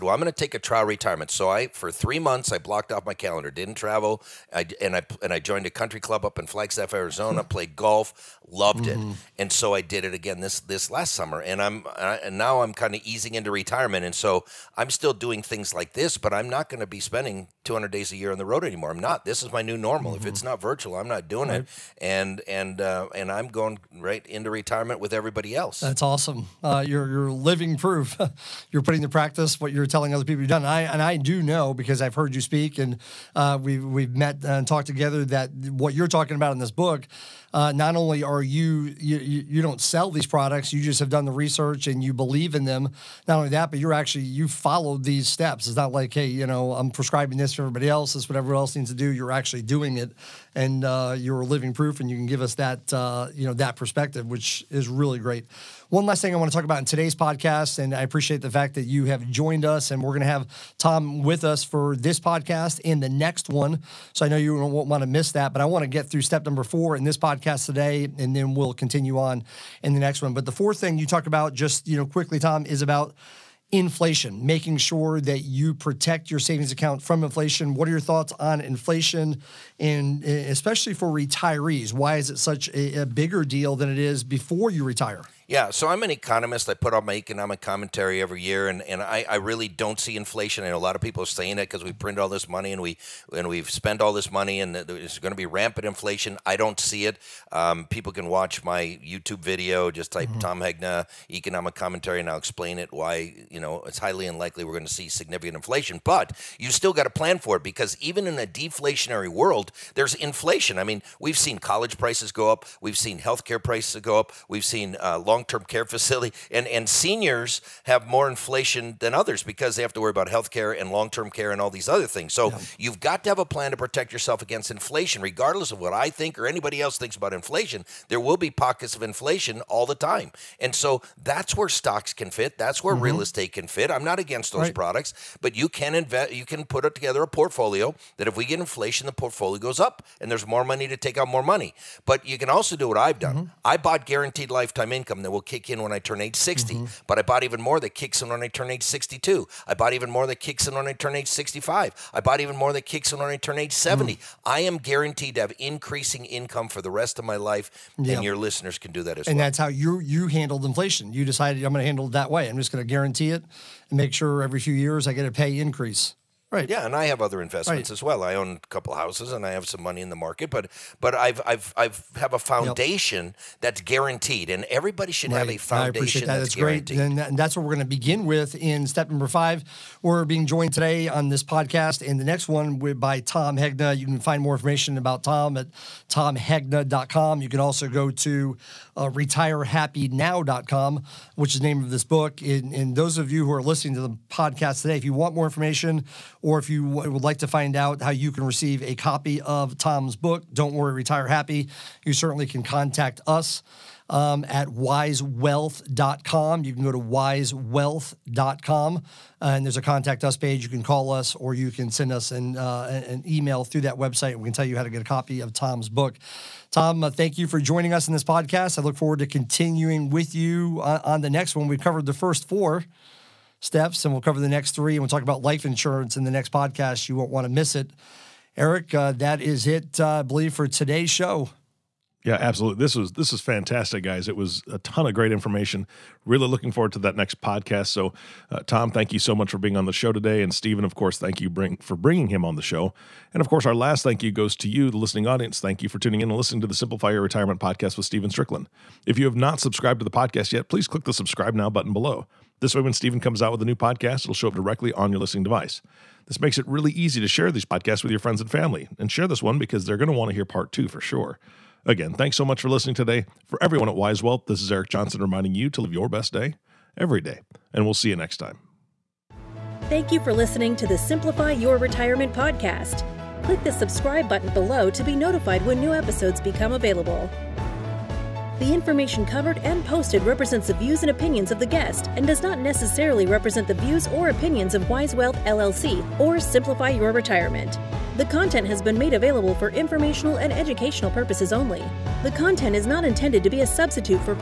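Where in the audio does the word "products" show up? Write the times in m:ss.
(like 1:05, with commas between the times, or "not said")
0:40, 2:14.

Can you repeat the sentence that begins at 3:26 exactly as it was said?
You can go to wisewealth.com uh, and there's a contact us page.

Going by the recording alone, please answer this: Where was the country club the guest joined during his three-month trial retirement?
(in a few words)
Flagstaff, Arizona.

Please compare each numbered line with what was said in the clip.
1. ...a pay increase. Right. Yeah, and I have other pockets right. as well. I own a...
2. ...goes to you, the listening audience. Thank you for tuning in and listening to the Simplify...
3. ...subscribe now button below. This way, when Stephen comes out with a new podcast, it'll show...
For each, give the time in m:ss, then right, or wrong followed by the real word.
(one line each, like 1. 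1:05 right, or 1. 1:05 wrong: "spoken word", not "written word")
1. 2:45 wrong: "investments", not "pockets"
2. 4:04 right
3. 4:11 right.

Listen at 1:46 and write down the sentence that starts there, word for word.
But you still got to plan for it because even in a deflationary world, there's inflation.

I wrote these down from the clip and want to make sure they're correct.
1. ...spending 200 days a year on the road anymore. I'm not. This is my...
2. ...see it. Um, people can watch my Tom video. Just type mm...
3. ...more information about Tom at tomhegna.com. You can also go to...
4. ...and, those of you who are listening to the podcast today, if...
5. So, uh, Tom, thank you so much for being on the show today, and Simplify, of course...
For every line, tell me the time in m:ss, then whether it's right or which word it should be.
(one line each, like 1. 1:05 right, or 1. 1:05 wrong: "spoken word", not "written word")
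1. 0:17 right
2. 1:36 wrong: "YouTube", not "Tom"
3. 3:04 right
4. 3:12 right
5. 3:57 wrong: "Stephen", not "Simplify".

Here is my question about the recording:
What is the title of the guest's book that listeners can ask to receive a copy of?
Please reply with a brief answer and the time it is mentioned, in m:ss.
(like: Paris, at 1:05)
Don't Worry, Retire Happy, at 3:20.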